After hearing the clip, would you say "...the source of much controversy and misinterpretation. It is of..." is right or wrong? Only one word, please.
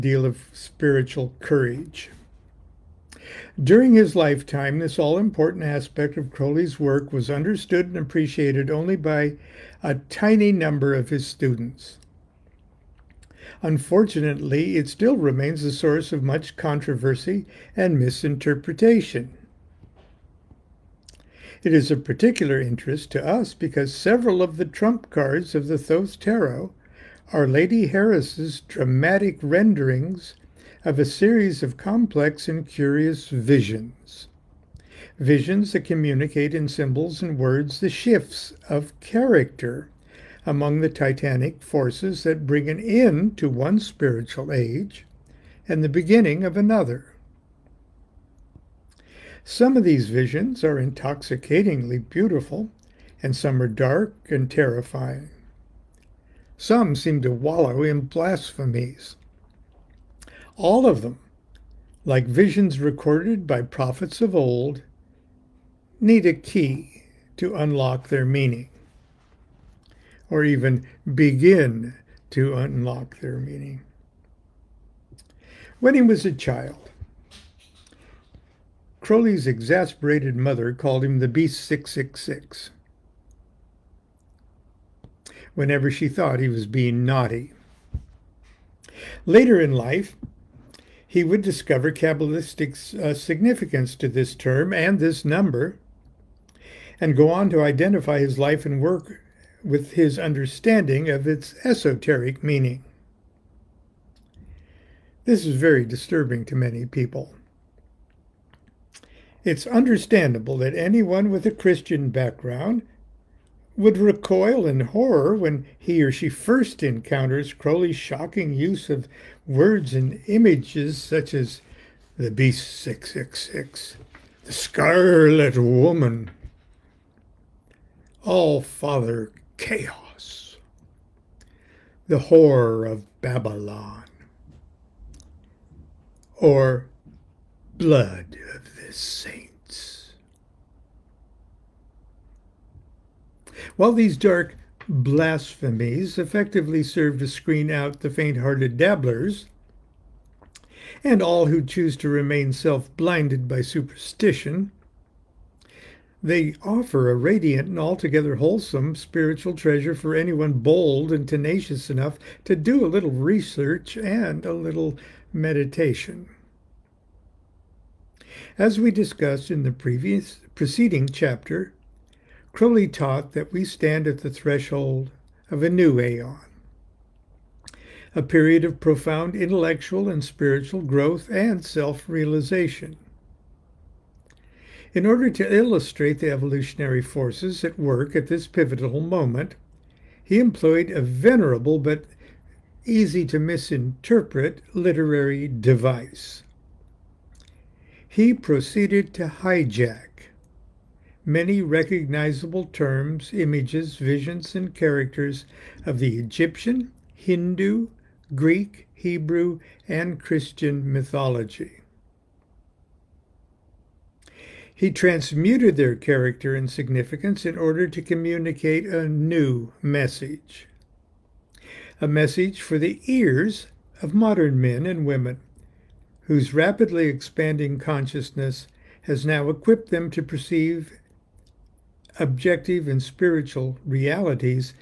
right.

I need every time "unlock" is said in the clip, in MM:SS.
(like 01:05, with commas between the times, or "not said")
01:07, 01:12.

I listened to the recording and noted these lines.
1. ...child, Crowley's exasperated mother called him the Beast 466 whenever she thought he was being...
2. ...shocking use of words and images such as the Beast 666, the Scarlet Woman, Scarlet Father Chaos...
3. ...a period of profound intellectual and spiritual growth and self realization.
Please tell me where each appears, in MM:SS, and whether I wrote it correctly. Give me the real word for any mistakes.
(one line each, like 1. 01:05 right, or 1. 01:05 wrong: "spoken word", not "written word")
1. 01:16 wrong: "666", not "466"
2. 01:57 wrong: "All", not "Scarlet"
3. 02:58 right.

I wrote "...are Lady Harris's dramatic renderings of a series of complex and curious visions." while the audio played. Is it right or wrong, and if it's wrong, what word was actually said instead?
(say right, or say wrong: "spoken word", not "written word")
right.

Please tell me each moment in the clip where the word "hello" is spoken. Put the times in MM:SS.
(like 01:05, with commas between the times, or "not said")
not said.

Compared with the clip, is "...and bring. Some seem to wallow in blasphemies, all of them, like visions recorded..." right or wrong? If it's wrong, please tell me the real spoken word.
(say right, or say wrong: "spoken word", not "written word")
wrong: "terrifying", not "bring".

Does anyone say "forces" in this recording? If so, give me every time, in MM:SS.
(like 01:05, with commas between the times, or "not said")
00:41, 03:06.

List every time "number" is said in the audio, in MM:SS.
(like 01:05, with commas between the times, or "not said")
00:10, 01:35.